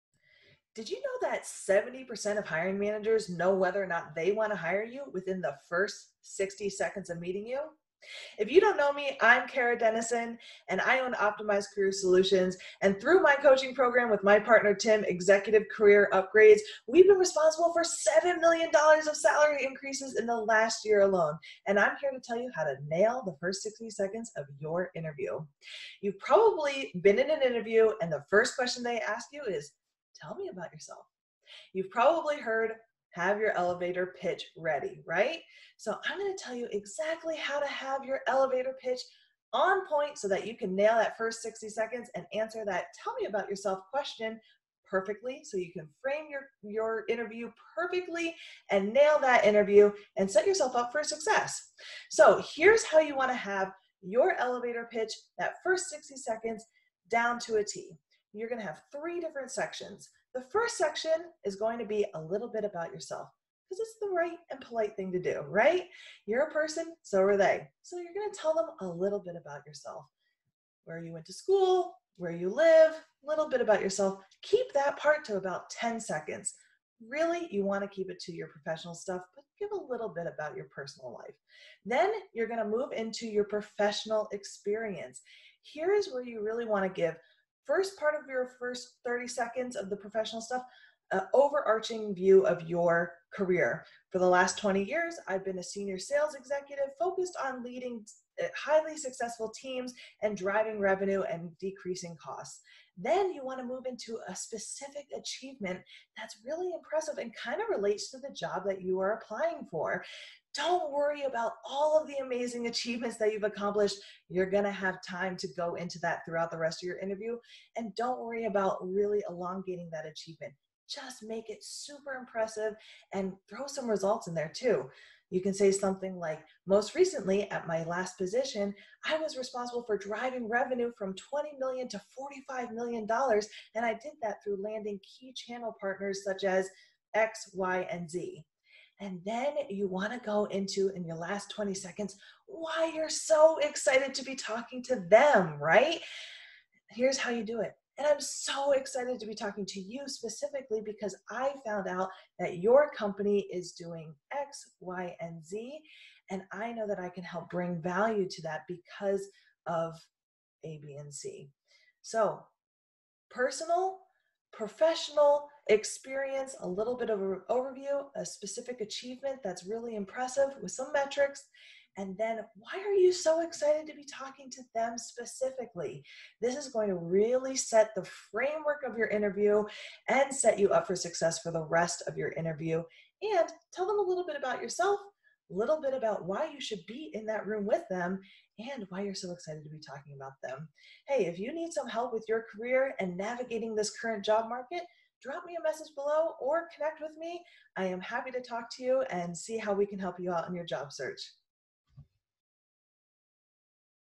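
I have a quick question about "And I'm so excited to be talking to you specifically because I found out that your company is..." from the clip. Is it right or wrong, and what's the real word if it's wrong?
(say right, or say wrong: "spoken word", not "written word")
right.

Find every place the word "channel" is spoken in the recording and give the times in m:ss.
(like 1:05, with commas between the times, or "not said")
2:15.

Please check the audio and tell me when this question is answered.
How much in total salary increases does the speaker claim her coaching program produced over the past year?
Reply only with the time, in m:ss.
0:17.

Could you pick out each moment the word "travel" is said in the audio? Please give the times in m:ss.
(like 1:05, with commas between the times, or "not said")
not said.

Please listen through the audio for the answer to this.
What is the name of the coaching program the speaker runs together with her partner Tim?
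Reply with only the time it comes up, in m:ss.
0:15.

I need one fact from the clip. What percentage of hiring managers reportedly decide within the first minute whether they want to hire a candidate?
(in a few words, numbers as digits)
70%.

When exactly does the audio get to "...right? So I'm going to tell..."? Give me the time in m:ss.
0:35.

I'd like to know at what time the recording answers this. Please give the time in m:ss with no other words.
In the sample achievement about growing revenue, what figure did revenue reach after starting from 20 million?
2:12.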